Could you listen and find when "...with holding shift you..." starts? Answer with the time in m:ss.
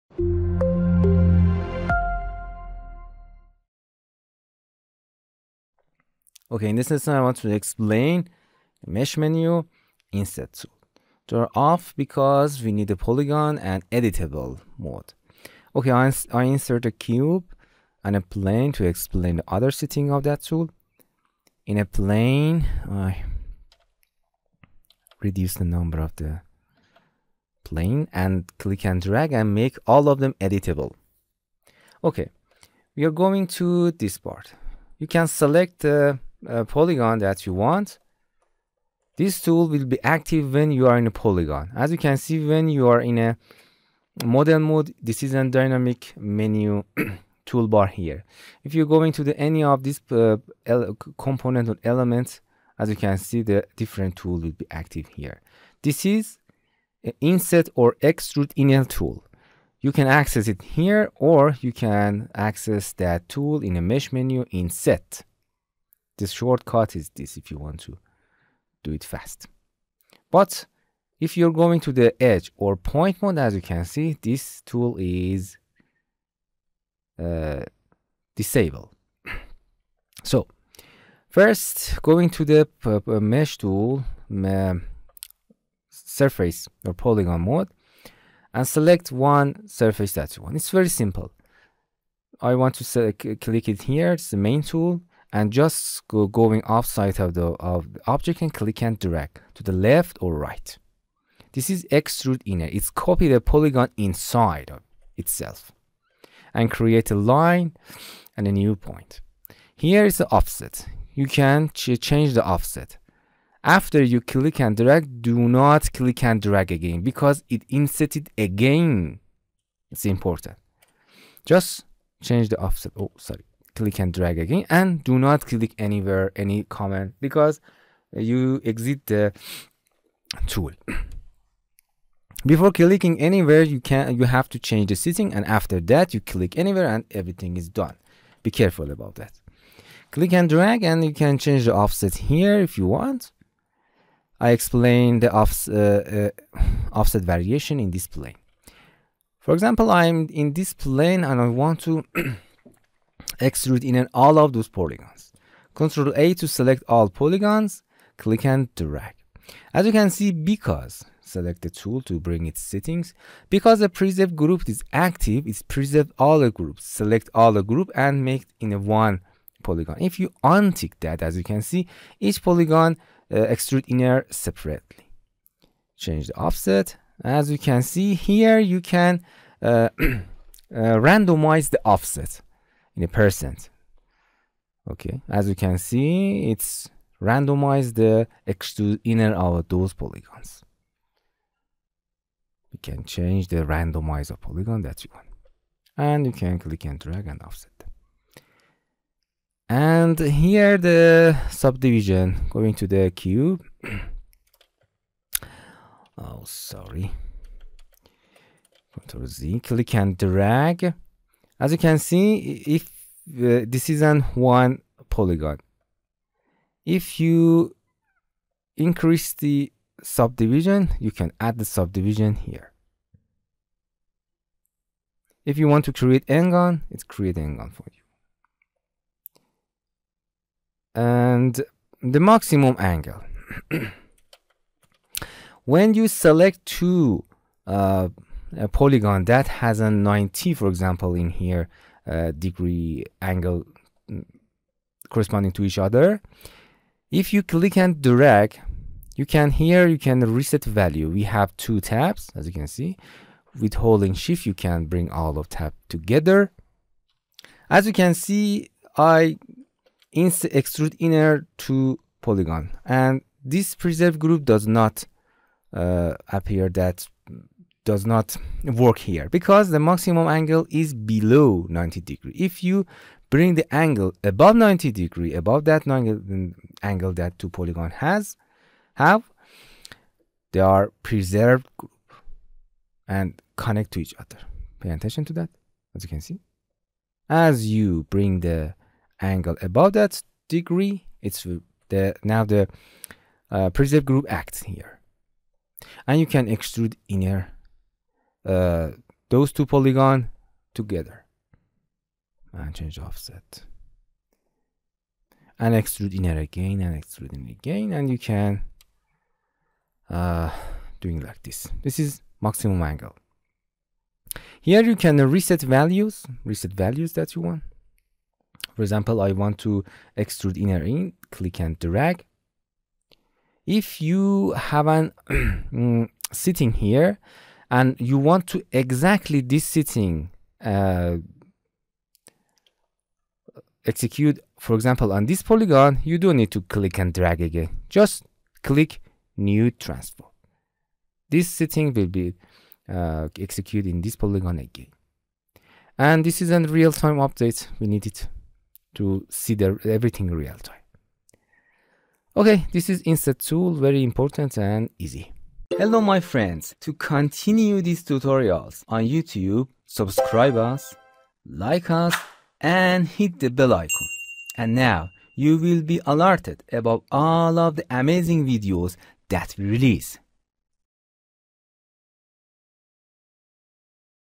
4:13.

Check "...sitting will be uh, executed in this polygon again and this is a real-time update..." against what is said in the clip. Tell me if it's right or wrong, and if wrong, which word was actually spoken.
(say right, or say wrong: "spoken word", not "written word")
right.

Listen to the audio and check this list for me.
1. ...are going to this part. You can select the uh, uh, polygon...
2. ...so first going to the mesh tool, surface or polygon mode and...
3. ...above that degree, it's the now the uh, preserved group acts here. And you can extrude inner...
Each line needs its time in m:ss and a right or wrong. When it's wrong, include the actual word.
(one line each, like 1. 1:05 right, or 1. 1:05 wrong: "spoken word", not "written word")
1. 0:33 right
2. 1:20 right
3. 4:49 right.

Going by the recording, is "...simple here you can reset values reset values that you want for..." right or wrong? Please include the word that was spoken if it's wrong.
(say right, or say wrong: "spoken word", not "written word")
wrong: "angle", not "simple".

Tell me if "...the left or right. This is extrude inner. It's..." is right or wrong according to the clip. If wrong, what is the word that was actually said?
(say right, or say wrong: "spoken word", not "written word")
right.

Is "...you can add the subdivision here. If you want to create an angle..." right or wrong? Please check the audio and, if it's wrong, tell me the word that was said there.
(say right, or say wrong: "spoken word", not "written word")
right.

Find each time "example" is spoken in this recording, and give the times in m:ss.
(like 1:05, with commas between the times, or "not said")
2:29, 4:00, 5:18, 5:34.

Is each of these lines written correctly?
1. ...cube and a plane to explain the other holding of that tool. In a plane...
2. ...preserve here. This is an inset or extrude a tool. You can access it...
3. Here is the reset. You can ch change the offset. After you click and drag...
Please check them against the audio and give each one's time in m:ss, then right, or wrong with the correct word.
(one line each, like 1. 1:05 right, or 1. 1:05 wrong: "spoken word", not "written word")
1. 0:16 wrong: "setting", not "holding"
2. 0:54 wrong: "active", not "preserve"
3. 1:49 wrong: "offset", not "reset".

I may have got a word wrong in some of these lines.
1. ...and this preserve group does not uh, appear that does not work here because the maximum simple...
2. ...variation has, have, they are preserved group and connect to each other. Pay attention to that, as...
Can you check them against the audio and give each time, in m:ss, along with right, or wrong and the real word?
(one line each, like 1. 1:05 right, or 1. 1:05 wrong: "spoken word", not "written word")
1. 4:22 wrong: "angle", not "simple"
2. 4:37 wrong: "polygon", not "variation".